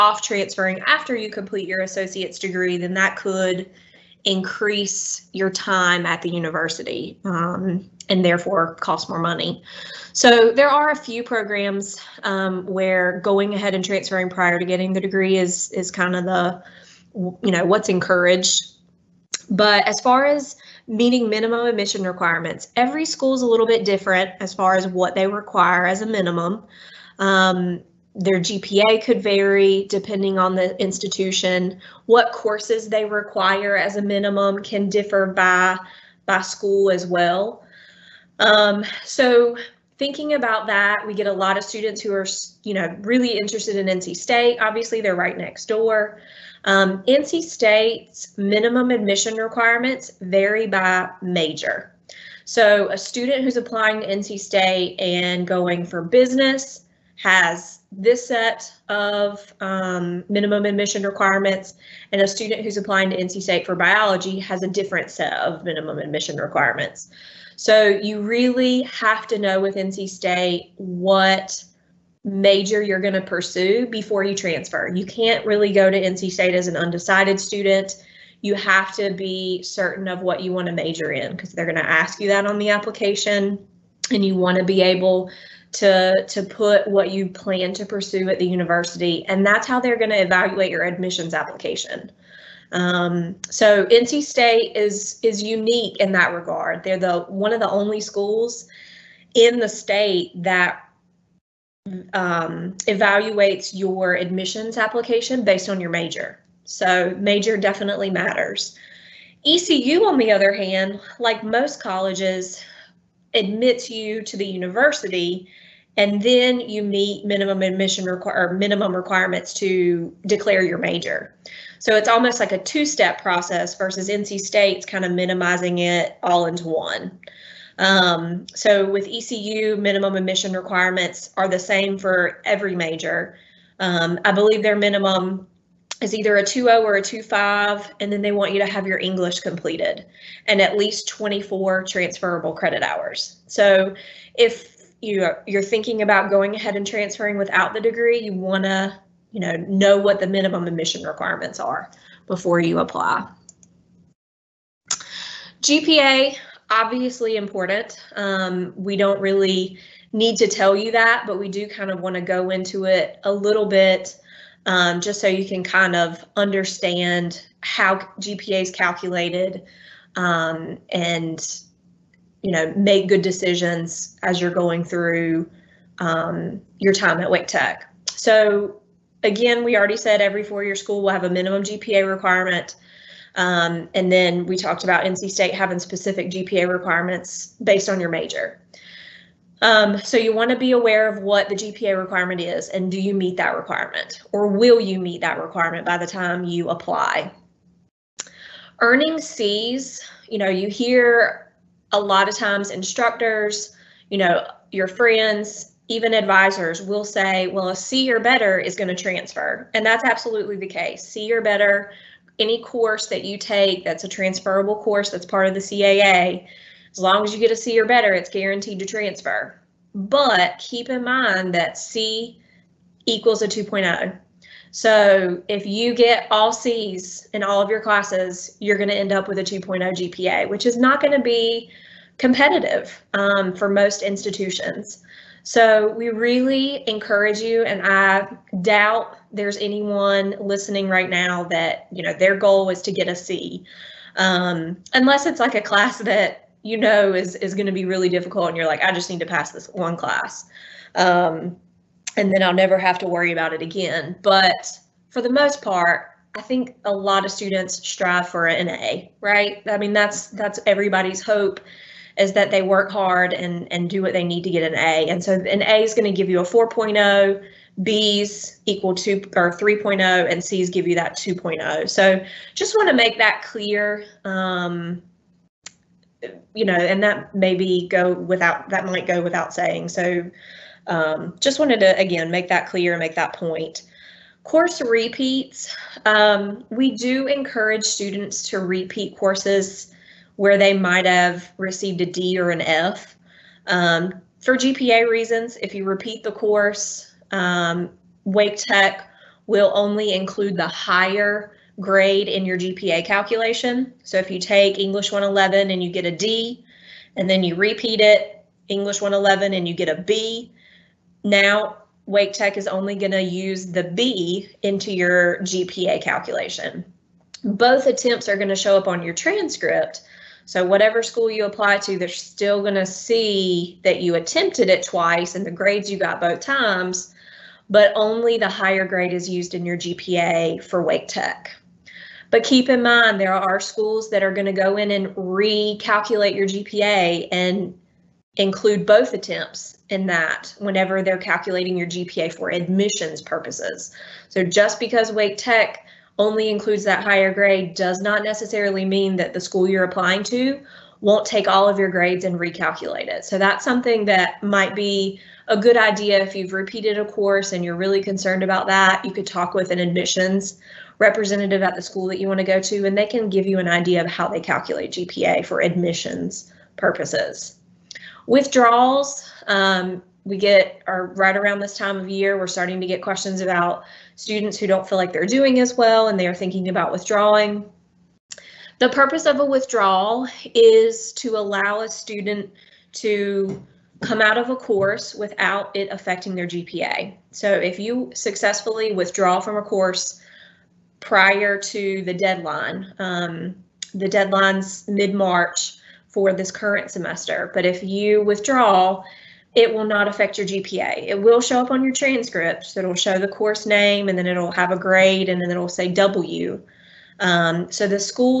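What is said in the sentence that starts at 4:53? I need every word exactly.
Um, for GPA reasons, if you repeat the course, um, Wake Tech will only include the higher grade in your GPA calculation.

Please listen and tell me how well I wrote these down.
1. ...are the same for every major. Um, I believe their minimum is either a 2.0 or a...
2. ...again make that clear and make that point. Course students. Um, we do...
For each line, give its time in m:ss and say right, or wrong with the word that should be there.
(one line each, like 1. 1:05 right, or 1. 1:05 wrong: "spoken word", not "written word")
1. 2:11 right
2. 4:41 wrong: "repeats", not "students".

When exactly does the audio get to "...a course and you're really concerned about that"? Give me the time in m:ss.
5:56.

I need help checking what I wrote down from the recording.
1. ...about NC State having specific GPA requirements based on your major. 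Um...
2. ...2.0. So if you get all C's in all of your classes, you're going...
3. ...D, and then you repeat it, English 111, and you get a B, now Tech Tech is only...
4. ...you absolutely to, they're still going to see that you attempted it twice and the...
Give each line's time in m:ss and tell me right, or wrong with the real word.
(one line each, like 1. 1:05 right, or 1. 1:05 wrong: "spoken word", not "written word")
1. 3:04 right
2. 3:43 right
3. 5:06 wrong: "Wake", not "Tech"
4. 5:21 wrong: "apply", not "absolutely".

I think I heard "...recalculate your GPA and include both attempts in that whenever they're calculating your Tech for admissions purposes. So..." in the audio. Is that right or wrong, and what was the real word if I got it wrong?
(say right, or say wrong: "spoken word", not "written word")
wrong: "GPA", not "Tech".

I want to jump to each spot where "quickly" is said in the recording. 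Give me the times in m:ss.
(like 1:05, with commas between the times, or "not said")
not said.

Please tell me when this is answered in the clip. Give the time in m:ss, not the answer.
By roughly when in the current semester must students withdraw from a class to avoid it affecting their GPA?
6:34.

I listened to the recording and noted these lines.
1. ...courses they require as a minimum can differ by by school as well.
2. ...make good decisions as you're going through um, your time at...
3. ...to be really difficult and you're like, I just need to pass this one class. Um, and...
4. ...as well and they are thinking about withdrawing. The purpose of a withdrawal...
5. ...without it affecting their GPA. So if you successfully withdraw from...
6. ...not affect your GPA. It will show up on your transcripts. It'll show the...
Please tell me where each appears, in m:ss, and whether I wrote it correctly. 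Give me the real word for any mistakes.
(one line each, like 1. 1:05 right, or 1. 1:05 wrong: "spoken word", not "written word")
1. 0:32 right
2. 2:52 right
3. 4:07 right
4. 6:15 right
5. 6:25 right
6. 6:39 right.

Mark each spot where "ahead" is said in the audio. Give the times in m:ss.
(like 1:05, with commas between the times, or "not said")
0:13, 2:26.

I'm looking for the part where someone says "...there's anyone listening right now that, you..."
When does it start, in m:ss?
3:59.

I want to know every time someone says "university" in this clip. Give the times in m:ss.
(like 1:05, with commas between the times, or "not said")
0:06, 1:28, 1:54.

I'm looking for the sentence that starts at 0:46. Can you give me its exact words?
Um, NC State's minimum admission requirements vary by major.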